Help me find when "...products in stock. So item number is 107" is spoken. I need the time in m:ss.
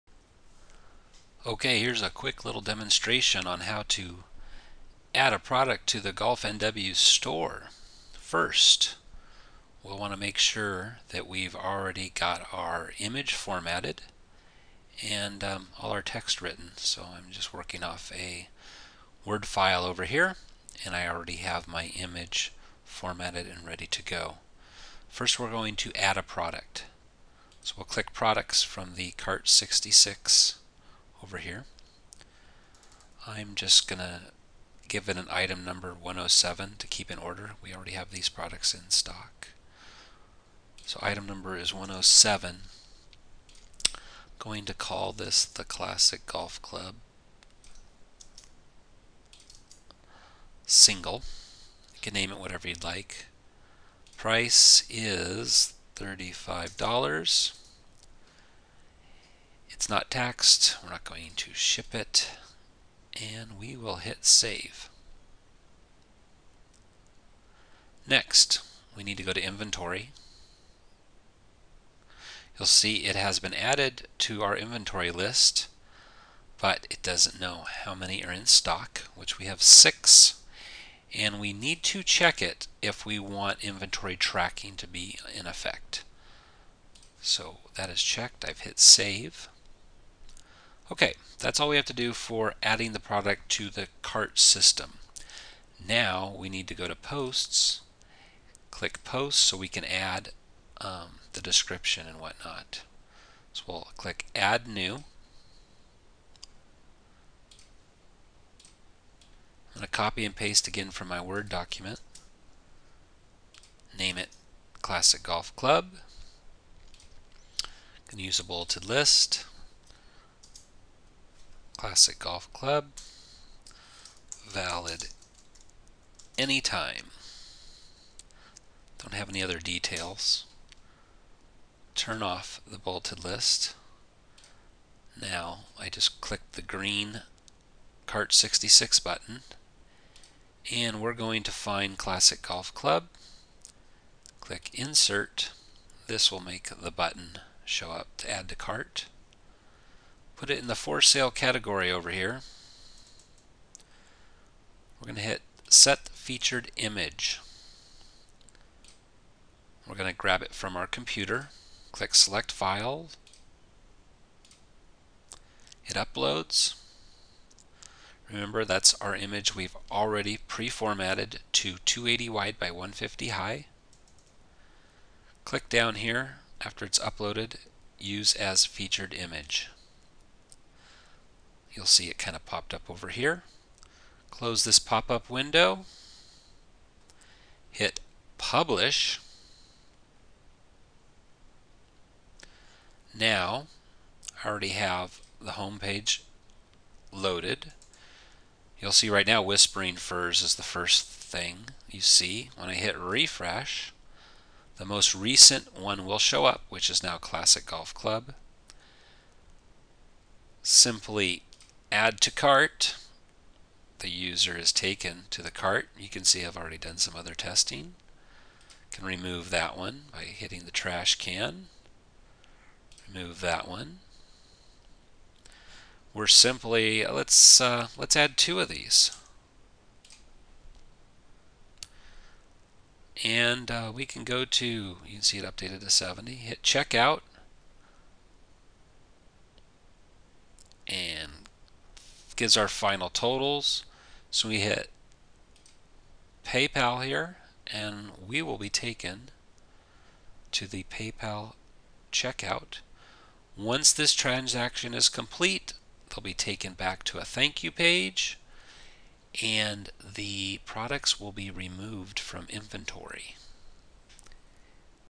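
0:38.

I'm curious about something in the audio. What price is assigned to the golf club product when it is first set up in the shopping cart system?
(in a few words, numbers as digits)
$35.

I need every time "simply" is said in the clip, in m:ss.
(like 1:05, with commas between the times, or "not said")
3:30, 3:46.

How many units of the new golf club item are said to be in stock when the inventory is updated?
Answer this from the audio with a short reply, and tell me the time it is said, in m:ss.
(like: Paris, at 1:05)
6, at 1:19.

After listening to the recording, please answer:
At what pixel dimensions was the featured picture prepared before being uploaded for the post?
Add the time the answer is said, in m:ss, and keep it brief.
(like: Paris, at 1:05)
280 wide by 150 high, at 2:51.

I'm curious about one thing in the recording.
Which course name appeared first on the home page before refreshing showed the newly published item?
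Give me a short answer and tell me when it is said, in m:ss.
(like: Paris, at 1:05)
Whispering Firs, at 3:19.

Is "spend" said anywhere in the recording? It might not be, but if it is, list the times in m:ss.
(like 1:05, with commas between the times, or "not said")
not said.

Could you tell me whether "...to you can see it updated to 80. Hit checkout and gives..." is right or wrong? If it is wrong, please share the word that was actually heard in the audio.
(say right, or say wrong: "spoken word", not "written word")
wrong: "70", not "80".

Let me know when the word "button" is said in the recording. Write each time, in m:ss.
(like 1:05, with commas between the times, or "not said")
2:19, 2:26.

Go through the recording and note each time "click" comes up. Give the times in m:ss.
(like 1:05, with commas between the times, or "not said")
0:27, 1:38, 1:43, 2:16, 2:24, 2:41, 2:55.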